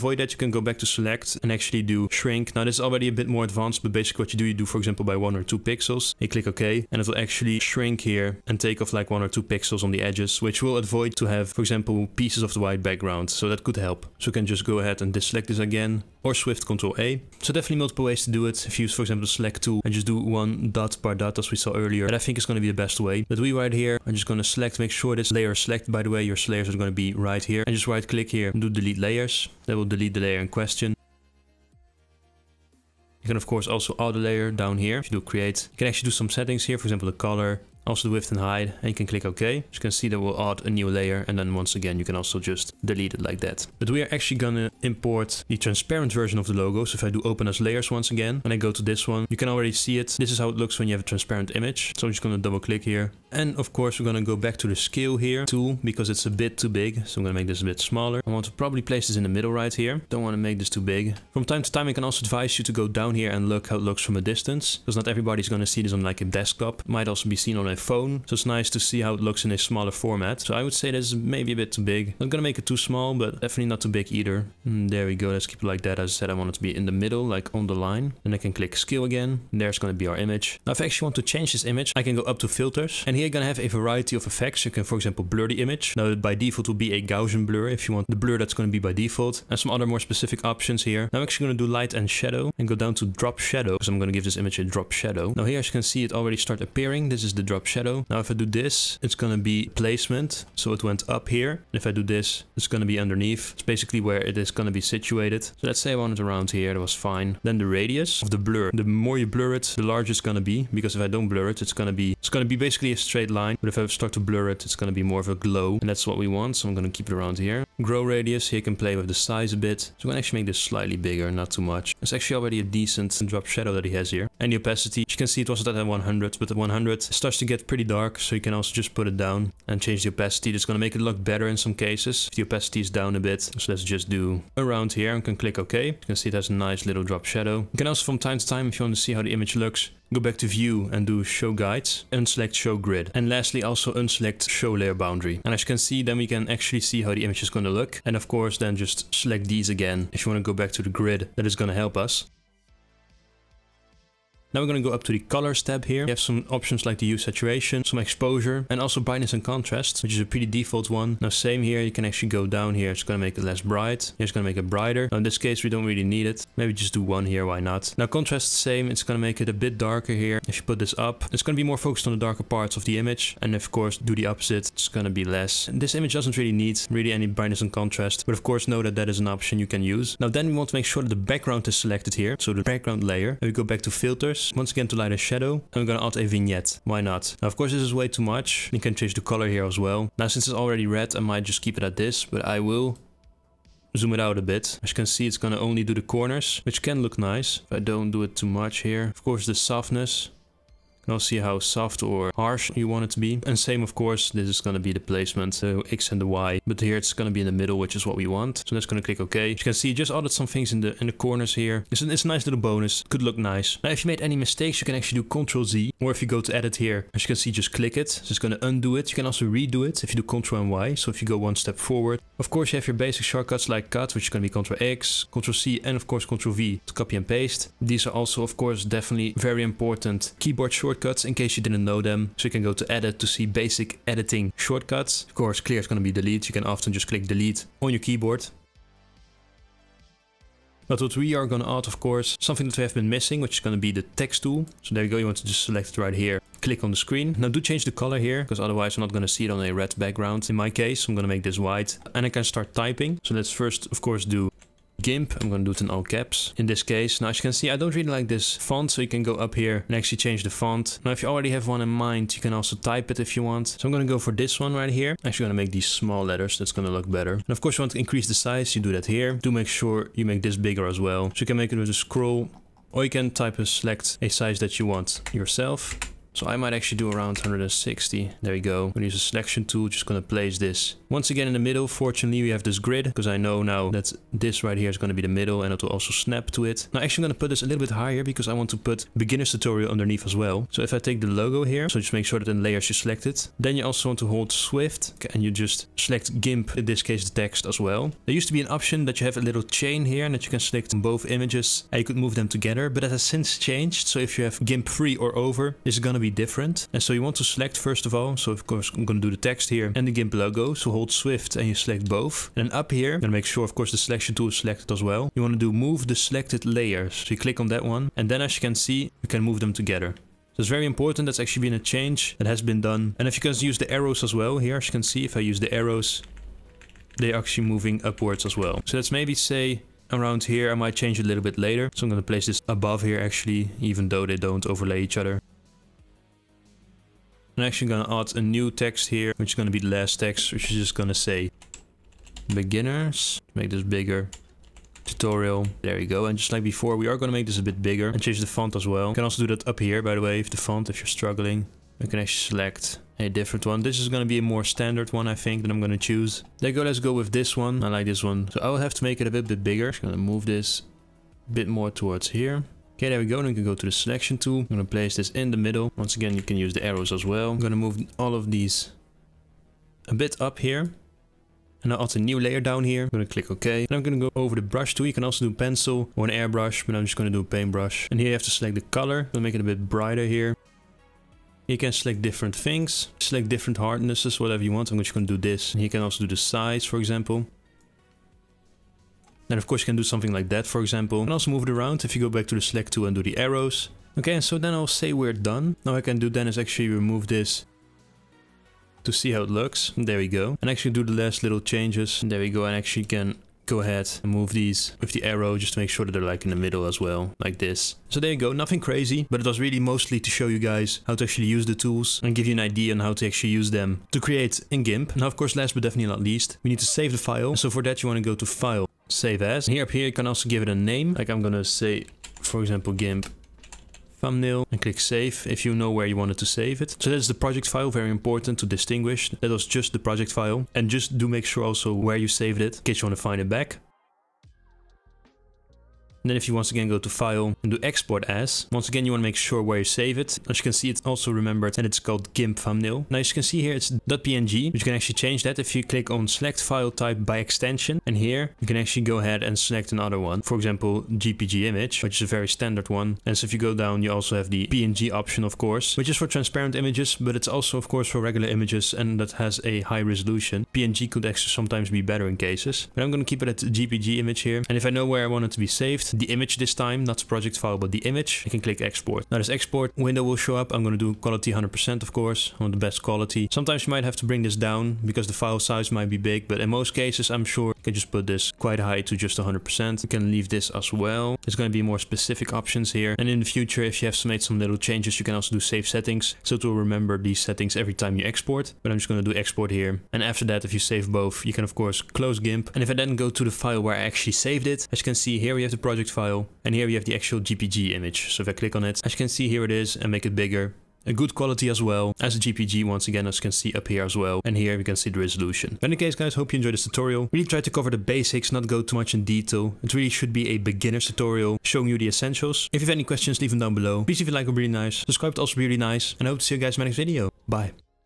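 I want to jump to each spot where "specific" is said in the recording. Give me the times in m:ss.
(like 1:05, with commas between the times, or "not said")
1:29, 8:01.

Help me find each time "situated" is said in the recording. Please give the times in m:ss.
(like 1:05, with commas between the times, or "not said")
1:44.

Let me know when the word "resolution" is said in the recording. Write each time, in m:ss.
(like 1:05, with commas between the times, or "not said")
7:40, 8:25.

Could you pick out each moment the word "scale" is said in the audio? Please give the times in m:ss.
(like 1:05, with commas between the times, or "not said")
0:54, 1:18.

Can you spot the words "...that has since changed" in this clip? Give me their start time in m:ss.
5:03.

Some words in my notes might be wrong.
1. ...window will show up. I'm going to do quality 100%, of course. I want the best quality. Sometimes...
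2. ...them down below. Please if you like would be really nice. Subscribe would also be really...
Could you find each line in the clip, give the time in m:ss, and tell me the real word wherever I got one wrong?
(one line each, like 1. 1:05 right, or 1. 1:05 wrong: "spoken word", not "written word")
1. 7:49 right
2. 8:33 right.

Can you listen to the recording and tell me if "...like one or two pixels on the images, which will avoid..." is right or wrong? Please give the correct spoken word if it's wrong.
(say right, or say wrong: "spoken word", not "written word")
wrong: "edges", not "images".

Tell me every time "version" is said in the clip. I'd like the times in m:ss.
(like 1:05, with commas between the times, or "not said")
0:46.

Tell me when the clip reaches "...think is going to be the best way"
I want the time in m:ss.
0:22.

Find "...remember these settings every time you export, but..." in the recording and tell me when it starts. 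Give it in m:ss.
8:06.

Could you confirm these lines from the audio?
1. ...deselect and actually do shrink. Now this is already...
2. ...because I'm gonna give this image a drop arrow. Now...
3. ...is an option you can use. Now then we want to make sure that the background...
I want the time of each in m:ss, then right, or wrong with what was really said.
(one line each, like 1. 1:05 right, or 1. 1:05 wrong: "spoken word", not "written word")
1. 0:00 wrong: "select", not "deselect"
2. 1:33 wrong: "shadow", not "arrow"
3. 2:59 right.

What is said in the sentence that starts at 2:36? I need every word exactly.
We have some options like the hue saturation, some exposure, and also brightness and contrast, which is a pretty default one.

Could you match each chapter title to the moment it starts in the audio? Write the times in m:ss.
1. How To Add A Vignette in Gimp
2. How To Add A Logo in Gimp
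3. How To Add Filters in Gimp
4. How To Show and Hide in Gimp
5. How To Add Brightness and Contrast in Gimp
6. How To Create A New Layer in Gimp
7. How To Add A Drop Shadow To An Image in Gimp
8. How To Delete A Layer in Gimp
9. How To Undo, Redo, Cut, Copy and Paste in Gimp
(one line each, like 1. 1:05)
1. 2:59
2. 0:40
3. 1:19
4. 2:16
5. 2:31
6. 0:30
7. 1:30
8. 0:20
9. 3:33.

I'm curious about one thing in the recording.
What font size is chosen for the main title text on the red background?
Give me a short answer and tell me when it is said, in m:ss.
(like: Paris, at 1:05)
160, at 4:37.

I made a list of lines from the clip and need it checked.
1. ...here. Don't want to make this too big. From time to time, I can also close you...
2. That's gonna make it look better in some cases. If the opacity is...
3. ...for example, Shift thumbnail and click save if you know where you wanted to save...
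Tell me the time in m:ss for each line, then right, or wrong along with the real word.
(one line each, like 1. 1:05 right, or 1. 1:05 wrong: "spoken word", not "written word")
1. 0:59 wrong: "advise", not "close"
2. 2:10 right
3. 7:02 wrong: "GIMP", not "Shift".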